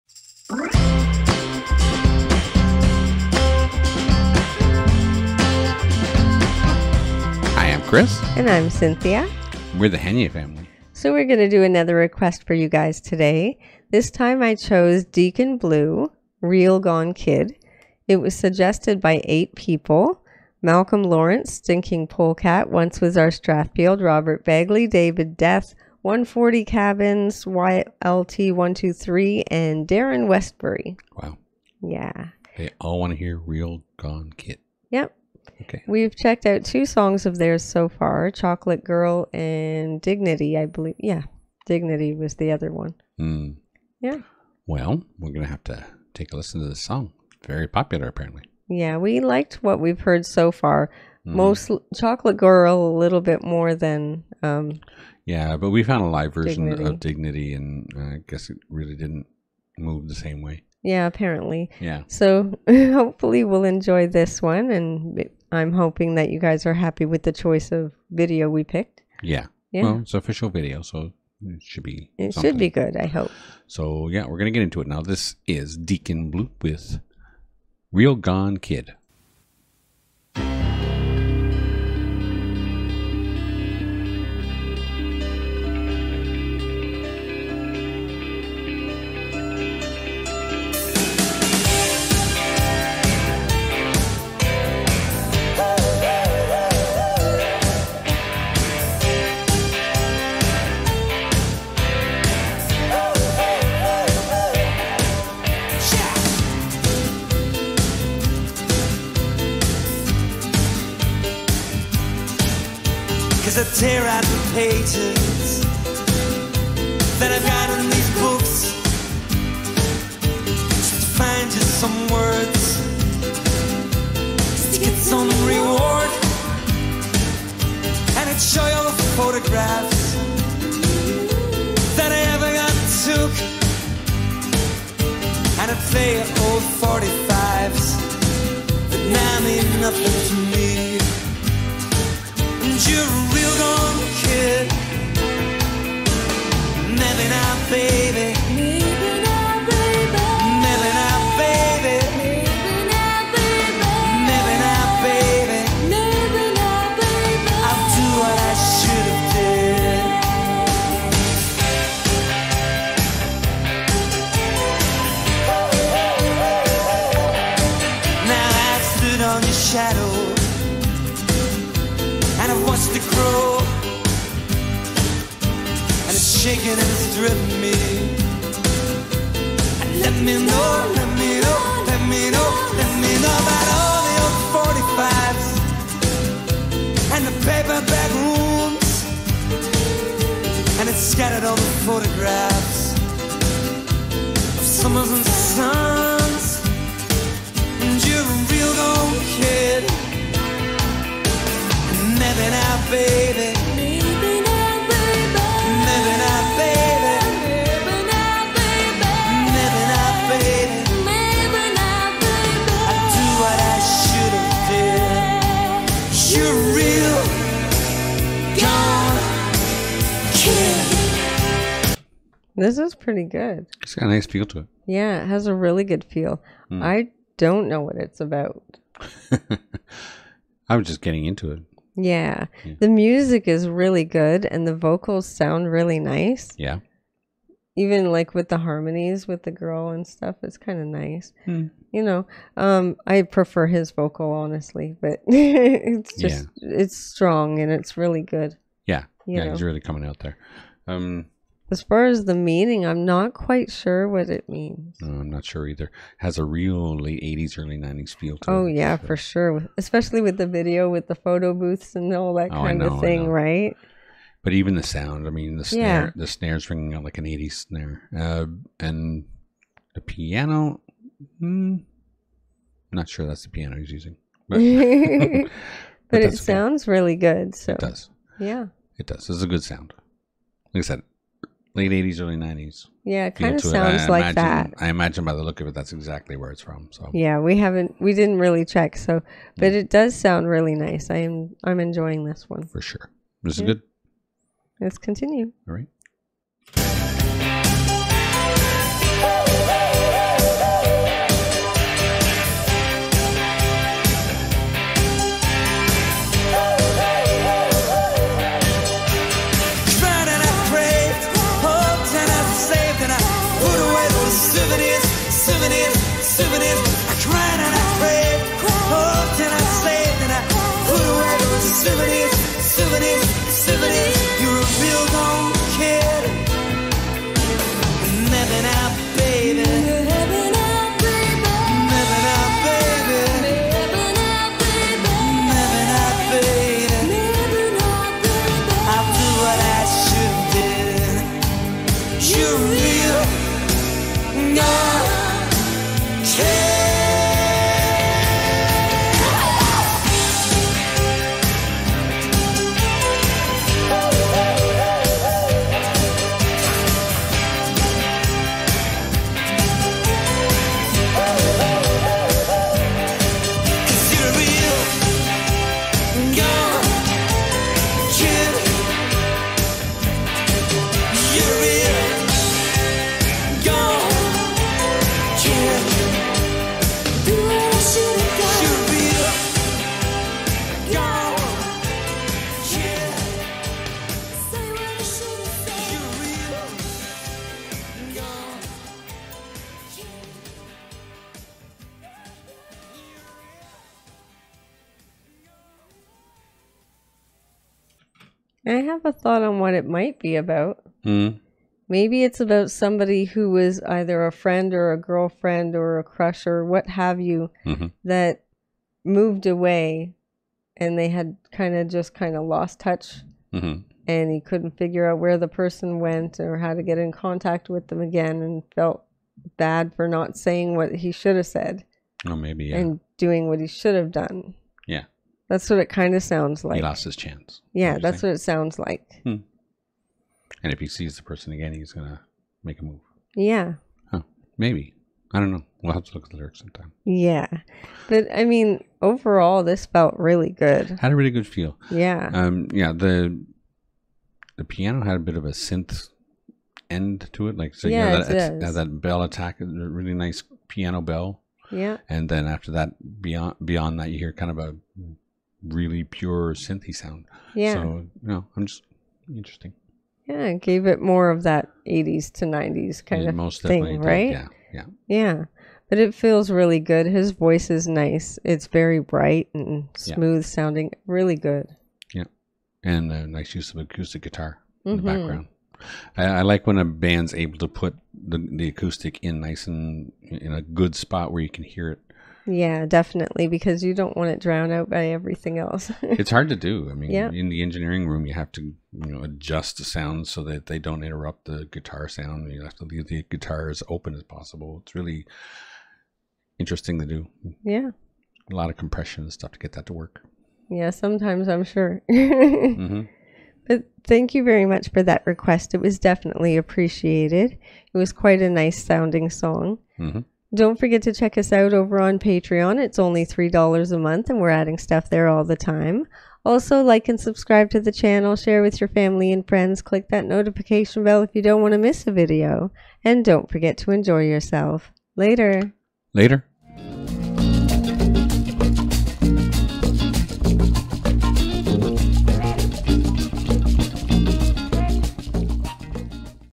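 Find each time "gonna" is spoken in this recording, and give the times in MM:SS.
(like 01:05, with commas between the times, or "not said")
01:14, 07:11.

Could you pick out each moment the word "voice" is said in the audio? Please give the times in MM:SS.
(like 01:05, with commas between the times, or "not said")
07:47.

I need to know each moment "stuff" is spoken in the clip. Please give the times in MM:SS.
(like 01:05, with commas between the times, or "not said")
04:00, 08:19, 08:34.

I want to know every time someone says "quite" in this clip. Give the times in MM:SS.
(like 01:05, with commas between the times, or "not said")
04:13, 08:28.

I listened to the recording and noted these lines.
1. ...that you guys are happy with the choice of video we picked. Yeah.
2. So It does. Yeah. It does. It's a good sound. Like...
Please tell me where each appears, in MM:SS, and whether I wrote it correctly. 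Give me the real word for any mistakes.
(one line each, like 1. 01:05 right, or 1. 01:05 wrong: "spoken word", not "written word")
1. 01:06 right
2. 04:37 right.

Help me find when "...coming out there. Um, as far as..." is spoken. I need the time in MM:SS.
04:09.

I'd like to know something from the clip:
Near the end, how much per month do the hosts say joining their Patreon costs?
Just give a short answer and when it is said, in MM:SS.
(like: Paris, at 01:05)
$3, at 08:33.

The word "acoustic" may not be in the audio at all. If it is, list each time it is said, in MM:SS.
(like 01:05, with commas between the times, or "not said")
07:53, 07:58.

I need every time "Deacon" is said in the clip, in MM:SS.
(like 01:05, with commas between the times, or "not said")
00:15, 01:15.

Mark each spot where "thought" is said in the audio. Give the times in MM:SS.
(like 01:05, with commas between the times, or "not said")
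06:39.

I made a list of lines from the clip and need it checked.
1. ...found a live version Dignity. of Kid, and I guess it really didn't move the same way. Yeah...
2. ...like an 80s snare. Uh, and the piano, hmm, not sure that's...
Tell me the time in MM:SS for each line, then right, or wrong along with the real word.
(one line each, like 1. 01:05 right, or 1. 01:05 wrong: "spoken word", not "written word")
1. 00:55 wrong: "Dignity", not "Kid"
2. 04:27 right.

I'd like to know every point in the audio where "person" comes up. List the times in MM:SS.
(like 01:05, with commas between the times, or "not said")
06:55, 07:11.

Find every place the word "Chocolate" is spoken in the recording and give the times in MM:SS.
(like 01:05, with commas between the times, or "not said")
00:38, 00:51.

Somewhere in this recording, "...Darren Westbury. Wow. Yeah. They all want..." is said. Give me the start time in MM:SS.
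00:29.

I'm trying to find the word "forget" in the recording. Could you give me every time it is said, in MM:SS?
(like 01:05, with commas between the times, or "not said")
08:30, 08:43.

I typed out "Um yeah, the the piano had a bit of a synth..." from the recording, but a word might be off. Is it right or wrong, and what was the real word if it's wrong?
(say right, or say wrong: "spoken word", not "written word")
right.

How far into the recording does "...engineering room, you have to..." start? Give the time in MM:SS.
08:07.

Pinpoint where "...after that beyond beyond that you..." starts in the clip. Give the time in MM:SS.
07:32.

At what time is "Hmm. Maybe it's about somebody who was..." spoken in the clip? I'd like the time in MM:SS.
06:41.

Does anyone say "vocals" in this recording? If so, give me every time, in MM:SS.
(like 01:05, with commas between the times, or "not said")
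03:54, 04:03.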